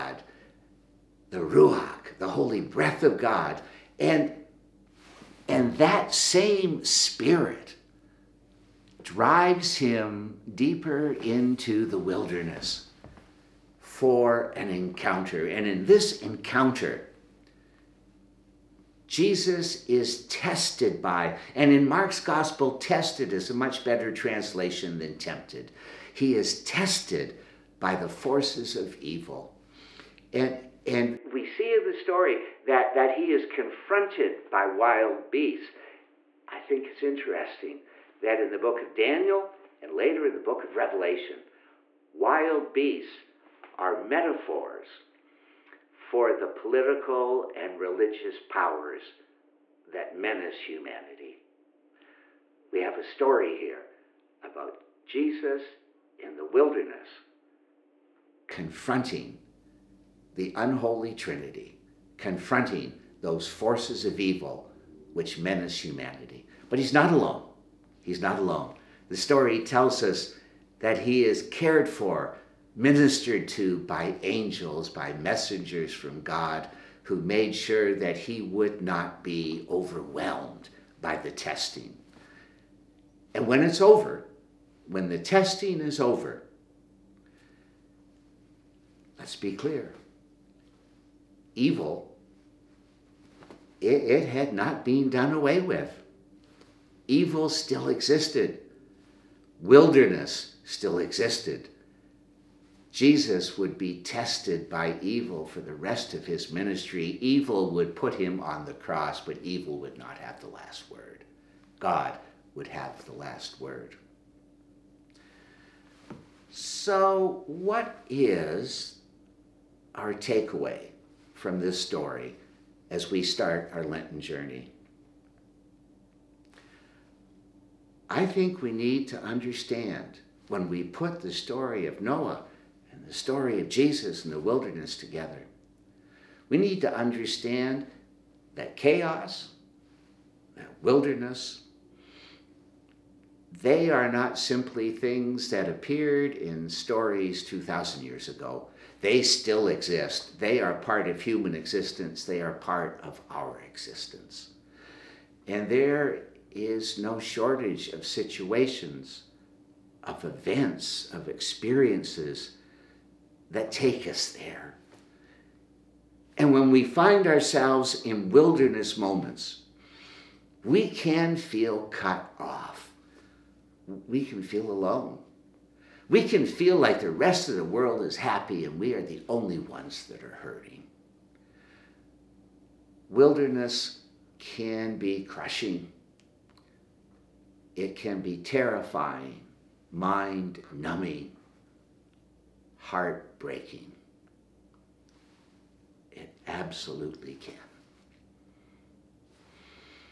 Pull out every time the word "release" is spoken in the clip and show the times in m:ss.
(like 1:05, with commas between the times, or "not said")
not said.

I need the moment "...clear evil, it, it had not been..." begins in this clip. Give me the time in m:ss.
1:29.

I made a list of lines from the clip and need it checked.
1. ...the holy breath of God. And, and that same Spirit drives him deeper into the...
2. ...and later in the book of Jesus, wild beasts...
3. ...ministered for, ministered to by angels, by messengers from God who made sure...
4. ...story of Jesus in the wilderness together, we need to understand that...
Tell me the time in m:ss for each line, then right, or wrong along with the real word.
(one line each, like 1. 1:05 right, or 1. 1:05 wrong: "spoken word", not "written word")
1. 0:02 right
2. 0:39 wrong: "Revelation", not "Jesus"
3. 1:11 wrong: "cared", not "ministered"
4. 2:13 right.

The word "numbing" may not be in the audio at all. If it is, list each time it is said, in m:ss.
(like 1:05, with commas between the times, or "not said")
3:10.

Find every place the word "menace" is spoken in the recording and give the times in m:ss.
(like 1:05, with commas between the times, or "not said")
0:50, 1:05.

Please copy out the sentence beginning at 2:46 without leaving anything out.
And when we find ourselves in wilderness moments, we can feel cut off.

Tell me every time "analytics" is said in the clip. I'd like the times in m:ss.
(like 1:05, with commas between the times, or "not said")
not said.